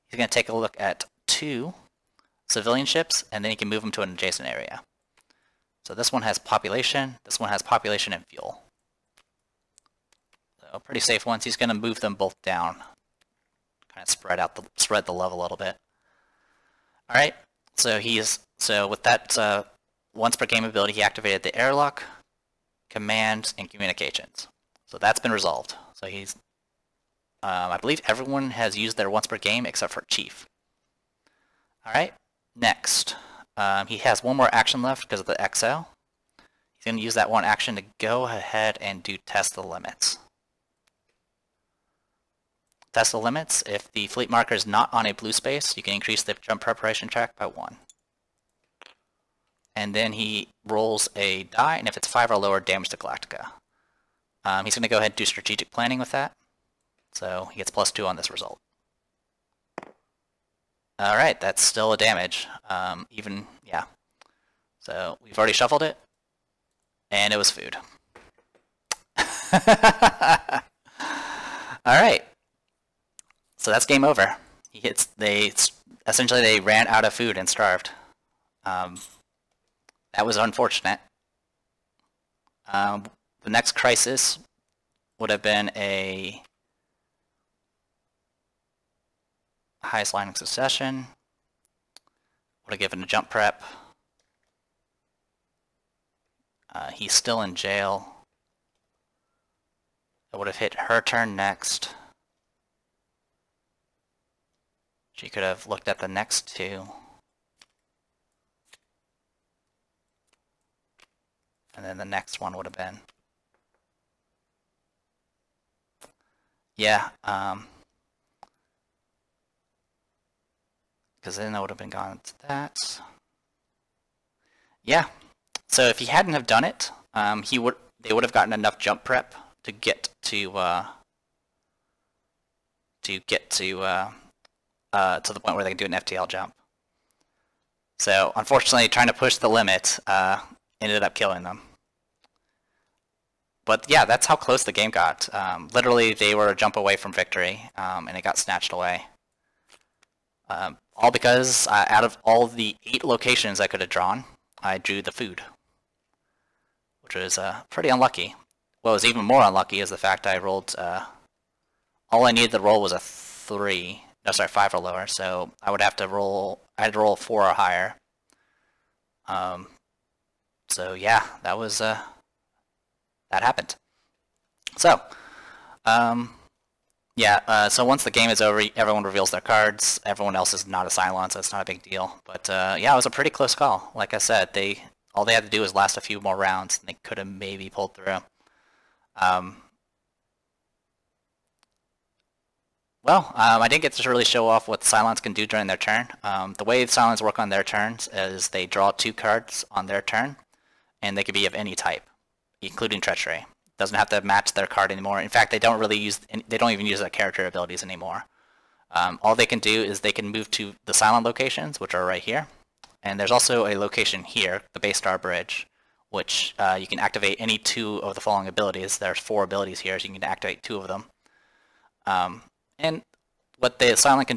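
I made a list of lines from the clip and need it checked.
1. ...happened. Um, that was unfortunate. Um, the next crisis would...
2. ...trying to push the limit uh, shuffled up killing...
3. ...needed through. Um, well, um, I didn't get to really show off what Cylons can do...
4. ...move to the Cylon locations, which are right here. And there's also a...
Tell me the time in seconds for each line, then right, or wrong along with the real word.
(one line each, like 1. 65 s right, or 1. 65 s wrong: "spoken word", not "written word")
1. 77 s wrong: "starved", not "happened"
2. 138 s wrong: "ended", not "shuffled"
3. 187 s wrong: "pulled", not "needed"
4. 210 s right.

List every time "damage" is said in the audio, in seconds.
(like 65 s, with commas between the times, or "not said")
52 s, 61 s.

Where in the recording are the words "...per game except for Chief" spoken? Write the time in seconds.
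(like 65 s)
29 s.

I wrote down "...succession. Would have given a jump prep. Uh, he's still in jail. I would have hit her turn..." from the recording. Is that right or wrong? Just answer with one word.
right.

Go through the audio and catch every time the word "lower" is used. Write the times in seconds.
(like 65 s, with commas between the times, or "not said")
52 s, 164 s.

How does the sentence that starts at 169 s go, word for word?
Um, so yeah, that was, uh, that happened.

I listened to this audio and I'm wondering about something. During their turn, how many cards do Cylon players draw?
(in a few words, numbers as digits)
2.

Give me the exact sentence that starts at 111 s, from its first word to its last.
And then the next one would have been.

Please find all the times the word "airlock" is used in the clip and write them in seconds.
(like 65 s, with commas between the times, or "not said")
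21 s.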